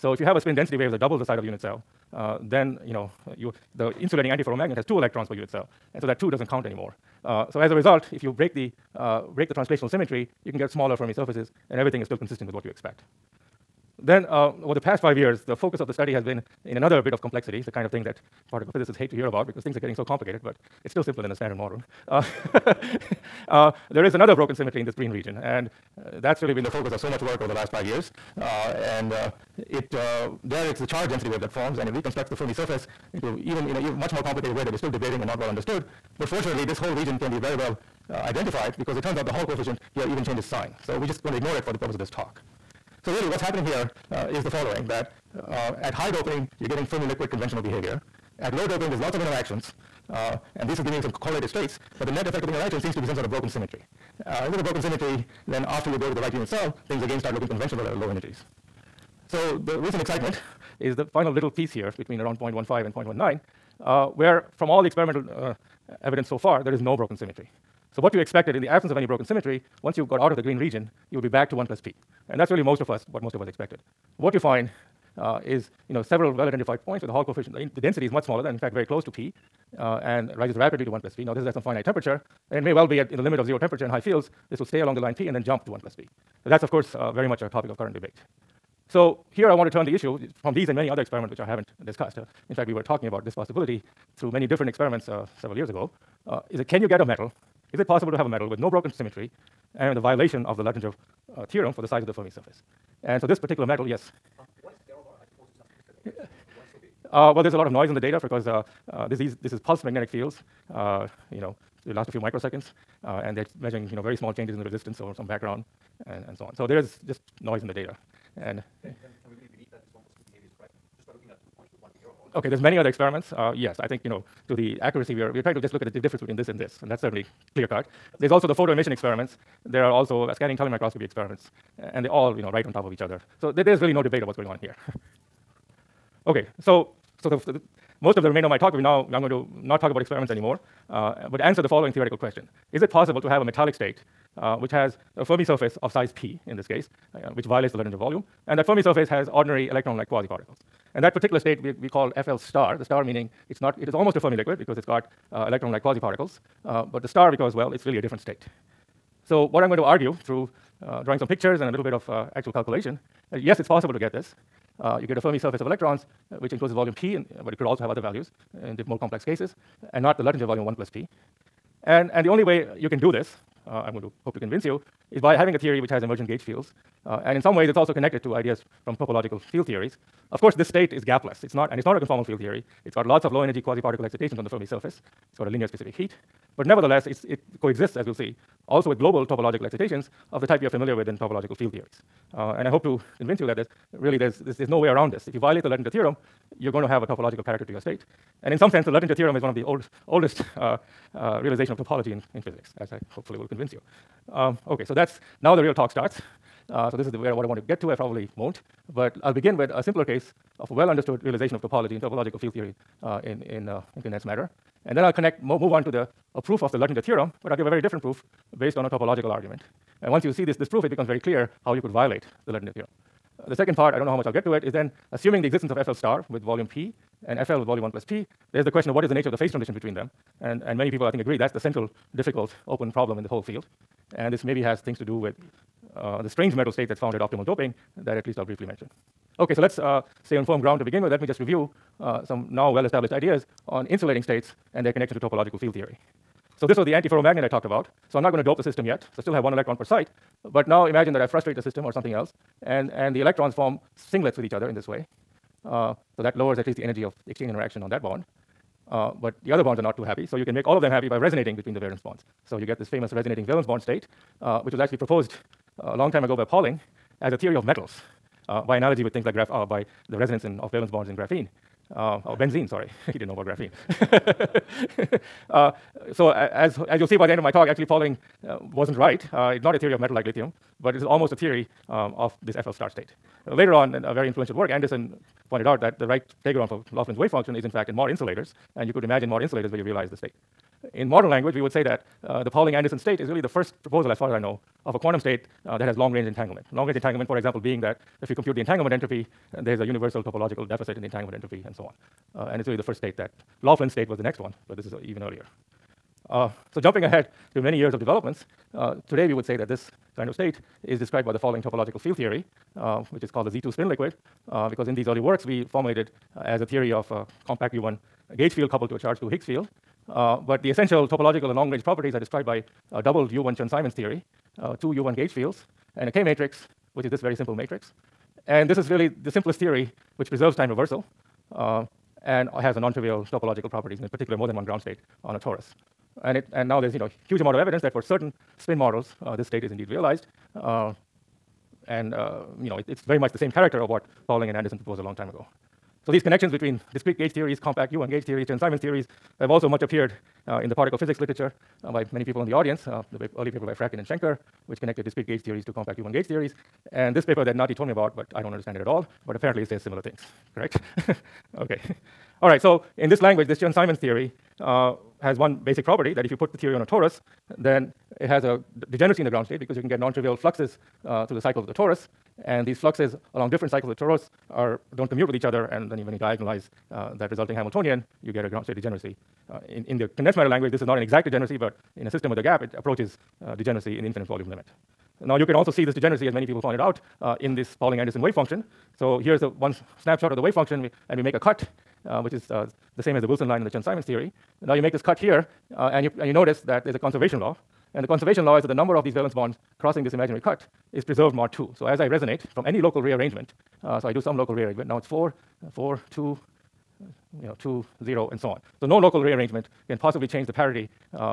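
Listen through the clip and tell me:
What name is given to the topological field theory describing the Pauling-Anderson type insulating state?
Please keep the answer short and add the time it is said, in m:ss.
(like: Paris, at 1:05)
Z2 spin liquid, at 5:13.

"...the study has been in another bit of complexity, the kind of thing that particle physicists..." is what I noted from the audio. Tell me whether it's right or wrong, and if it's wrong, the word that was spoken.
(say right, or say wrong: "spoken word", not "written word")
right.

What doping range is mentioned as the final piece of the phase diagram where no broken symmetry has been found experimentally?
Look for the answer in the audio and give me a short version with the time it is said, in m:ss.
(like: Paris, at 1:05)
0.15 to 0.19, at 1:02.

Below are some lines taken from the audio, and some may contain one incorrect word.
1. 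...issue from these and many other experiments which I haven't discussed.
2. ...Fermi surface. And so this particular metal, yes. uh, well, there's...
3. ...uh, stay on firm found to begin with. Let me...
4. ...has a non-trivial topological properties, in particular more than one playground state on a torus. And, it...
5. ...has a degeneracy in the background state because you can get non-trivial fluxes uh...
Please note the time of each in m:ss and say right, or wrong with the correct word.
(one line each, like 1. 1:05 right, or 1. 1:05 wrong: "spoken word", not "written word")
1. 1:29 right
2. 1:42 right
3. 3:59 wrong: "ground", not "found"
4. 5:32 wrong: "ground", not "playground"
5. 6:08 wrong: "ground", not "background".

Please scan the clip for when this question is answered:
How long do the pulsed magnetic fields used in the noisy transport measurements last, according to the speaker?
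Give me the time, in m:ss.
1:52.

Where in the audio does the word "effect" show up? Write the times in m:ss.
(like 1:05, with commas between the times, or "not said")
0:52.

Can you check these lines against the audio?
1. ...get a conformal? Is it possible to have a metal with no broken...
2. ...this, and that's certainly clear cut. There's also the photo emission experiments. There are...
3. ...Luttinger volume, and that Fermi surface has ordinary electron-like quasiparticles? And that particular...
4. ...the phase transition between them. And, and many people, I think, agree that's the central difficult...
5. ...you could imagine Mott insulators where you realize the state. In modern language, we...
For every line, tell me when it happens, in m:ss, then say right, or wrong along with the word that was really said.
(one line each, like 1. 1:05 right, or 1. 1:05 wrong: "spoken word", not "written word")
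1. 1:36 wrong: "metal", not "conformal"
2. 2:06 right
3. 2:27 right
4. 3:49 right
5. 4:48 right.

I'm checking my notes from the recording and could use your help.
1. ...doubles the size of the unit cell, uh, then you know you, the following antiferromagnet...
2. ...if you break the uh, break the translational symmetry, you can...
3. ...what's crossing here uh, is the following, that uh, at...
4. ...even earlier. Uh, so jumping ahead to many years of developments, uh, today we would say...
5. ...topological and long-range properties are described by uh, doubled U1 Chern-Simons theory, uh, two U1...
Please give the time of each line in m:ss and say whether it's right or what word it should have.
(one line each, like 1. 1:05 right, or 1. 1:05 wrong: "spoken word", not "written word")
1. 0:00 wrong: "insulating", not "following"
2. 0:08 right
3. 0:43 wrong: "happening", not "crossing"
4. 5:05 right
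5. 5:21 right.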